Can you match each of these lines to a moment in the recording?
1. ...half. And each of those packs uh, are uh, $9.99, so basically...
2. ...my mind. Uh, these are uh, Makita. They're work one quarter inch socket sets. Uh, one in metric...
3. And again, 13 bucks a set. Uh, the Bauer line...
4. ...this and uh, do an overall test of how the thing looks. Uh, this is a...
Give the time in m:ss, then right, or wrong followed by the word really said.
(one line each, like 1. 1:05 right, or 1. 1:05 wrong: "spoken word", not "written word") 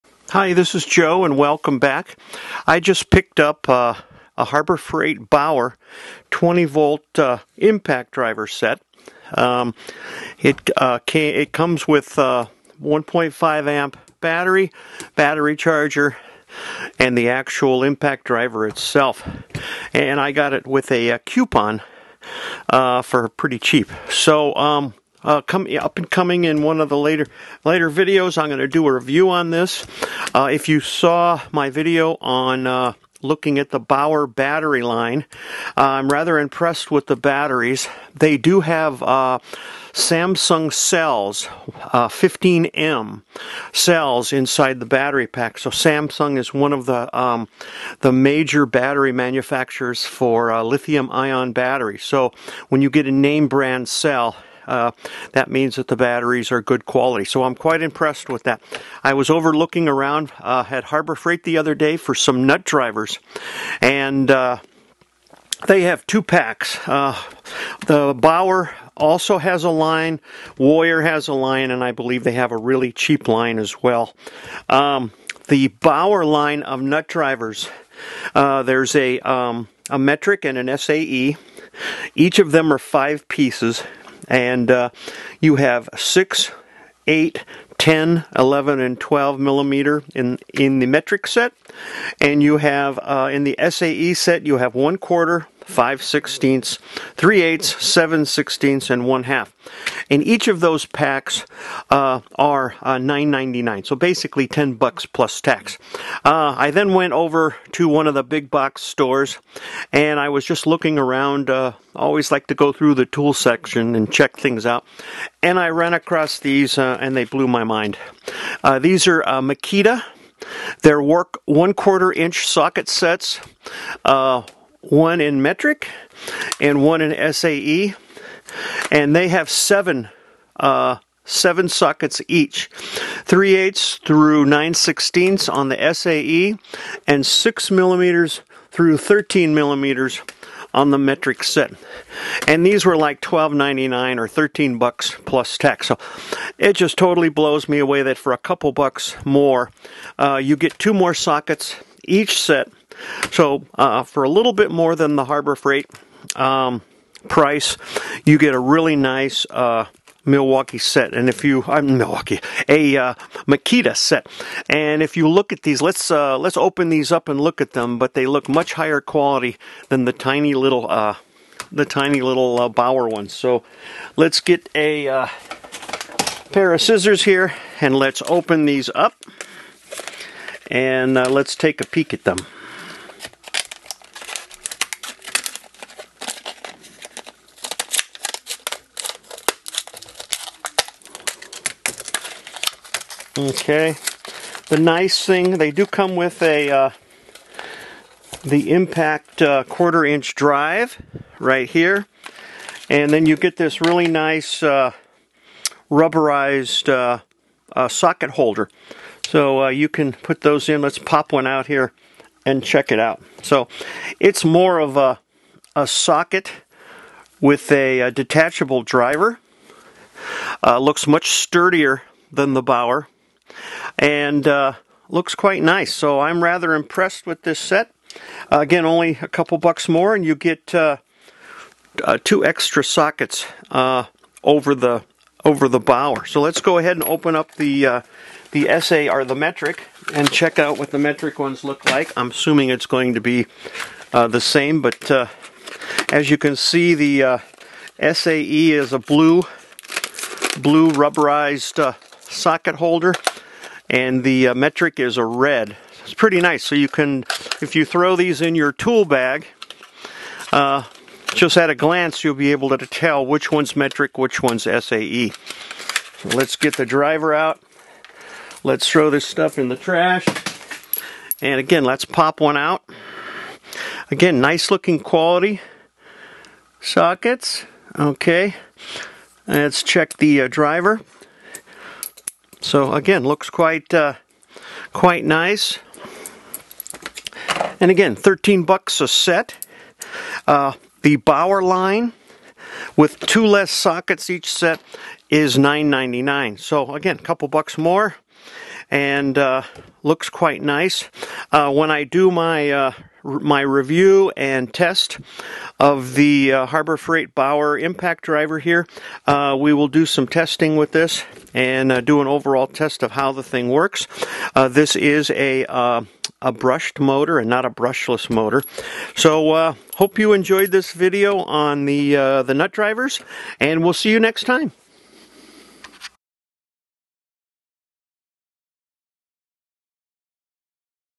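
1. 1:39 right
2. 1:57 right
3. 4:47 right
4. 5:10 wrong: "works", not "looks".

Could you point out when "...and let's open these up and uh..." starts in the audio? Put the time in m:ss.
2:57.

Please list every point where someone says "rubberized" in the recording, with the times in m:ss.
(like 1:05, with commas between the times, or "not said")
3:25, 4:10.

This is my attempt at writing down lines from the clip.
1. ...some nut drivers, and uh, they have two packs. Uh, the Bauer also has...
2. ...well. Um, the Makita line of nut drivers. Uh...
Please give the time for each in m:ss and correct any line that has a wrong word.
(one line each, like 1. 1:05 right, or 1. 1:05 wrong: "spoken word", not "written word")
1. 1:02 right
2. 1:13 wrong: "Bauer", not "Makita".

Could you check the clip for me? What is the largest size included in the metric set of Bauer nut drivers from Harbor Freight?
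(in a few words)
12 millimeter.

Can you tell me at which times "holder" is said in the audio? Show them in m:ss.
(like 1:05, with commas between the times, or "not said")
3:28, 4:12.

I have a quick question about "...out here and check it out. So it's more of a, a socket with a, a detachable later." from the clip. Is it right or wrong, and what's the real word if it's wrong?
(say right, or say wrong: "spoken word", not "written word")
wrong: "driver", not "later".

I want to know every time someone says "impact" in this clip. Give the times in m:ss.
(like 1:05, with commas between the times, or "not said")
0:07, 0:17, 3:18, 5:07.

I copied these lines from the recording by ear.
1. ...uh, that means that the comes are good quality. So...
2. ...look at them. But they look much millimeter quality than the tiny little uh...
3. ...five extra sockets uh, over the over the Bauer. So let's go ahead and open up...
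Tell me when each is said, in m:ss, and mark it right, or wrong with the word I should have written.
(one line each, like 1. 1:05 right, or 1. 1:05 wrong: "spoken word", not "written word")
1. 0:54 wrong: "batteries", not "comes"
2. 2:47 wrong: "higher", not "millimeter"
3. 3:52 wrong: "two", not "five".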